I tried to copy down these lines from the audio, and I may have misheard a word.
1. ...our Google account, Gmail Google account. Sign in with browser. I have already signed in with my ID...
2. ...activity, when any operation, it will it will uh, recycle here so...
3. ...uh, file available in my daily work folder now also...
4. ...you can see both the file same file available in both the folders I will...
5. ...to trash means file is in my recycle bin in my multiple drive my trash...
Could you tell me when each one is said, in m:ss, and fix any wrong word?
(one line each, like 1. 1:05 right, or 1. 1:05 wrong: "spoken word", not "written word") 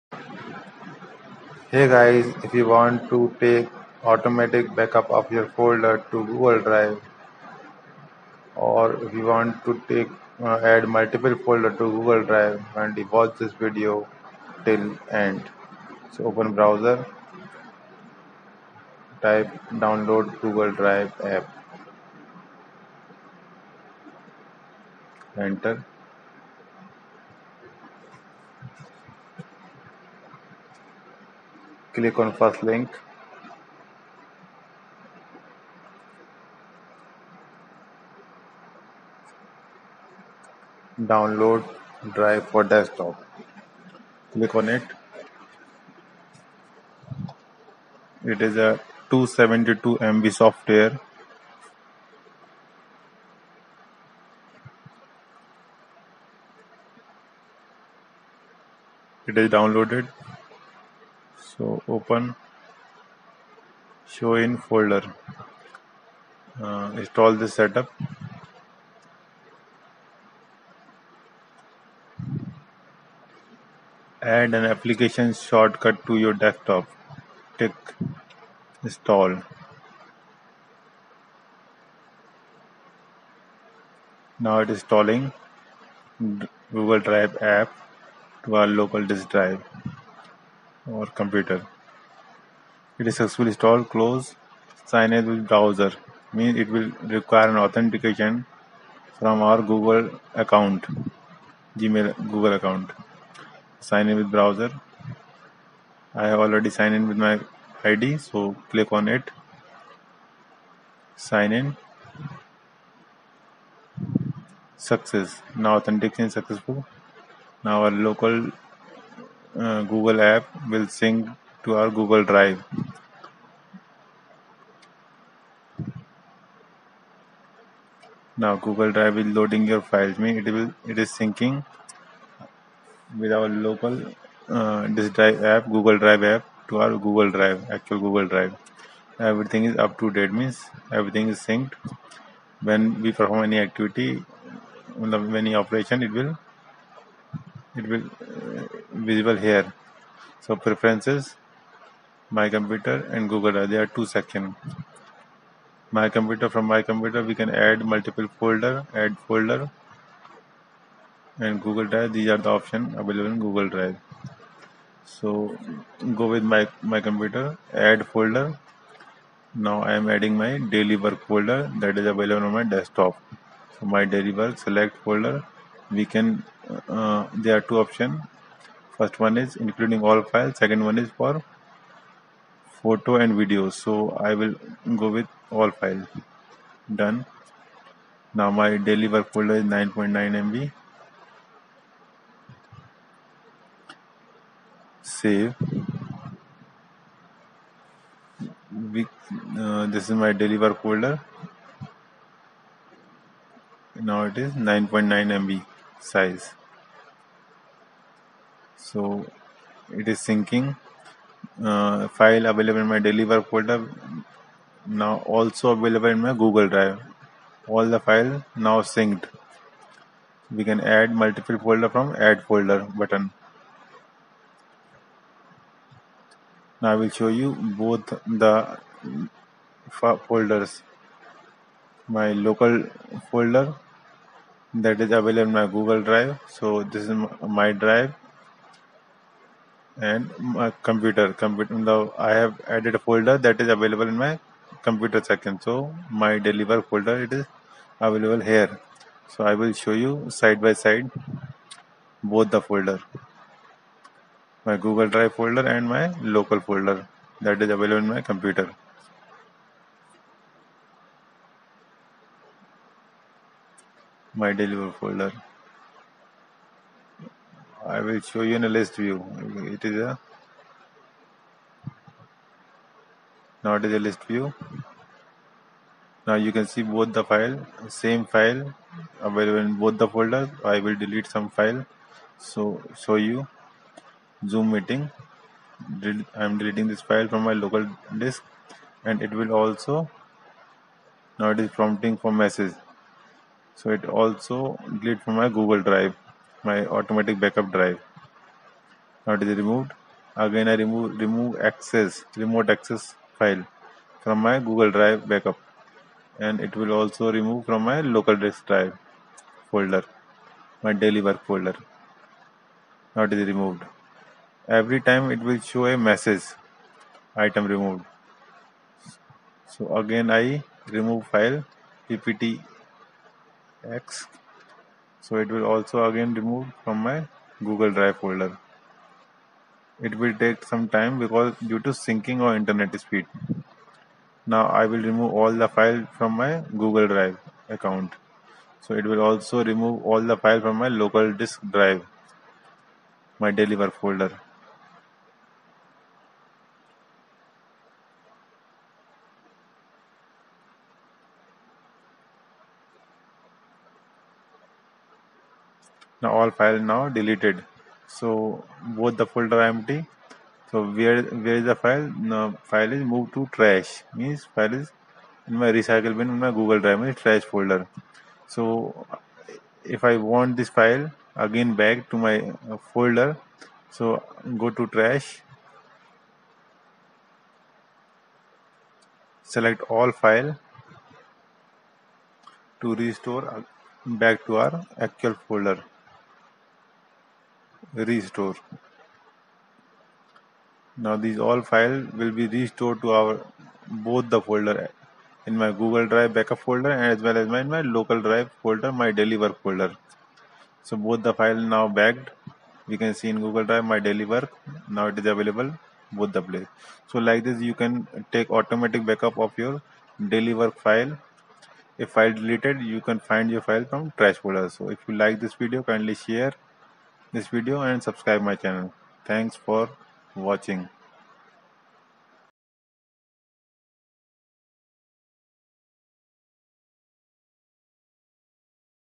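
1. 1:39 right
2. 2:23 wrong: "visible", not "recycle"
3. 3:31 right
4. 4:36 right
5. 6:03 wrong: "google", not "multiple".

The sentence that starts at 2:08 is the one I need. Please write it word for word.
Now Google Drive is loading your files.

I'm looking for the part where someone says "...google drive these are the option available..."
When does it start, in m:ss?
2:41.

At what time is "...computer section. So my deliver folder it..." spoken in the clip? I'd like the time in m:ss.
4:04.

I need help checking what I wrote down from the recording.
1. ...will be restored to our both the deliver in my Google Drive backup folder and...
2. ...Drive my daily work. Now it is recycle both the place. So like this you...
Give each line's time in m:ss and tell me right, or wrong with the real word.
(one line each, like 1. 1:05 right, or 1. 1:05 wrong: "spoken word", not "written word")
1. 6:32 wrong: "folder", not "deliver"
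2. 6:43 wrong: "available", not "recycle".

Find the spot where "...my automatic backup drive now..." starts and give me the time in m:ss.
4:56.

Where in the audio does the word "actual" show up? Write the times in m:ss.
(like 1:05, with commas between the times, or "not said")
2:17, 6:25.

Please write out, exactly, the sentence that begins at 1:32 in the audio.
It is successfully installed, close signage with browser.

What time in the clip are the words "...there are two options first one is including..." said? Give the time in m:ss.
2:57.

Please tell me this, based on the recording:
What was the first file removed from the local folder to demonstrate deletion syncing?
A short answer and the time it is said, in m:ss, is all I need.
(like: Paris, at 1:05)
zoom meeting, at 4:44.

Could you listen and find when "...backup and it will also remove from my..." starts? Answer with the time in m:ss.
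5:05.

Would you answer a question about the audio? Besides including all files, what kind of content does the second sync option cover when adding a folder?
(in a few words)
photo and video.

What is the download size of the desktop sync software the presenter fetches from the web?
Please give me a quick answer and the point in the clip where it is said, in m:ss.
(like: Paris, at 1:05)
272 MB, at 0:49.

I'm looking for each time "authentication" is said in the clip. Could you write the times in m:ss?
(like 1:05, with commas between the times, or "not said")
1:37, 1:55.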